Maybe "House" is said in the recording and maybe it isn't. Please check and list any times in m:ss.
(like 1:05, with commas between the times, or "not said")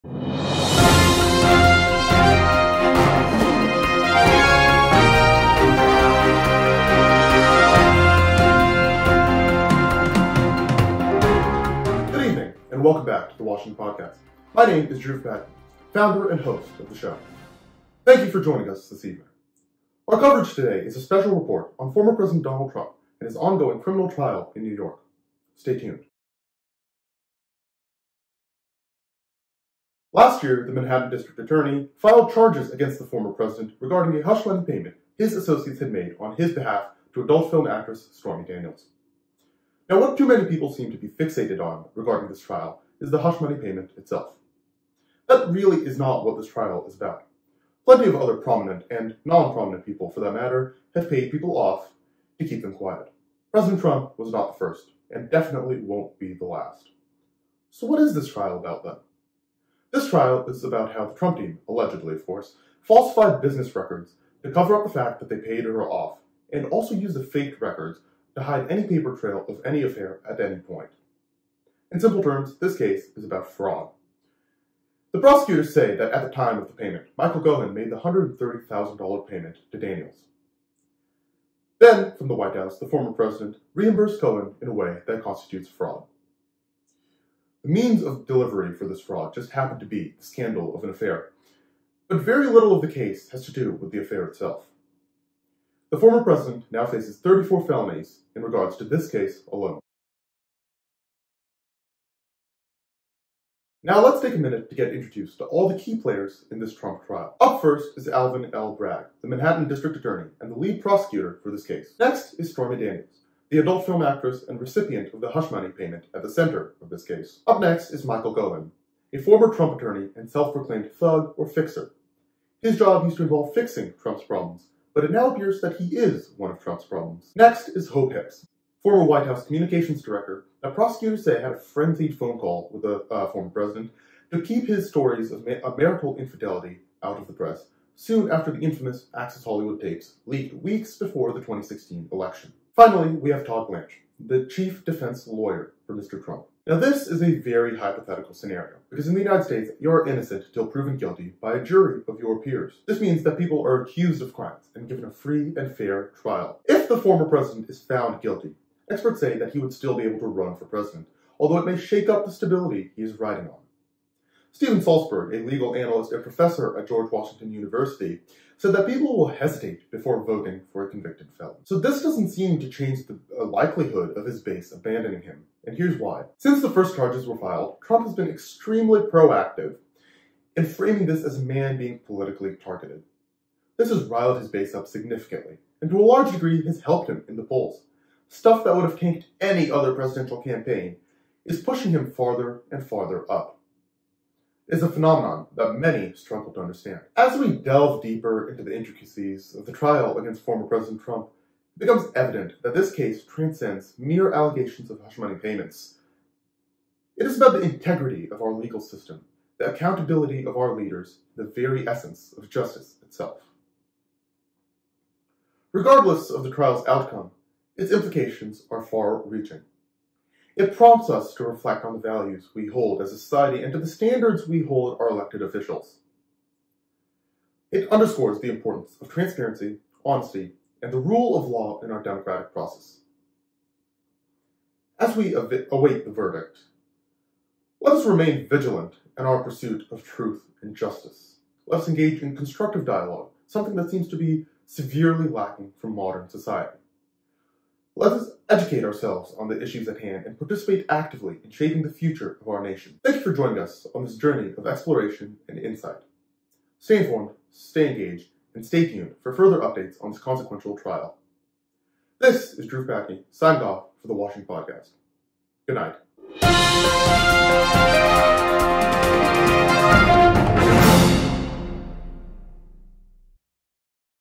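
1:22, 2:09.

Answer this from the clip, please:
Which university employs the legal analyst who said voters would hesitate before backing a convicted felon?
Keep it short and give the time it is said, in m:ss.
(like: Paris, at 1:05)
George Washington University, at 2:46.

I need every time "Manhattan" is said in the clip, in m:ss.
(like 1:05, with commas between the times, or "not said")
0:30, 1:49.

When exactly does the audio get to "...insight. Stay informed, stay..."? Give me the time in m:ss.
4:15.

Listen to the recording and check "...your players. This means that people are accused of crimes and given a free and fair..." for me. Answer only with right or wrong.
wrong.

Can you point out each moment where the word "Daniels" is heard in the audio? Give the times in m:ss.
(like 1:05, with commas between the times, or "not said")
0:38, 1:19, 1:52.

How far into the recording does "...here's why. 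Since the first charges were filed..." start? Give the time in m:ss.
2:55.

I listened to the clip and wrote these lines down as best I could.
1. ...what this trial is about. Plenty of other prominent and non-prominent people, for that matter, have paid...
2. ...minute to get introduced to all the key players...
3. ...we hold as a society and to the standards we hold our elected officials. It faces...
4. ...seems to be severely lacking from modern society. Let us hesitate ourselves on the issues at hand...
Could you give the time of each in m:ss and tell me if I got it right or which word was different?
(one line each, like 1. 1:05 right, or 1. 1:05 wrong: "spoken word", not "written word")
1. 0:46 right
2. 1:44 right
3. 3:42 wrong: "underscores", not "faces"
4. 4:03 wrong: "educate", not "hesitate".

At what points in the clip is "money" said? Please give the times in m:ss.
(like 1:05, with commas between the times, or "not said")
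0:34, 0:43, 1:55, 3:25.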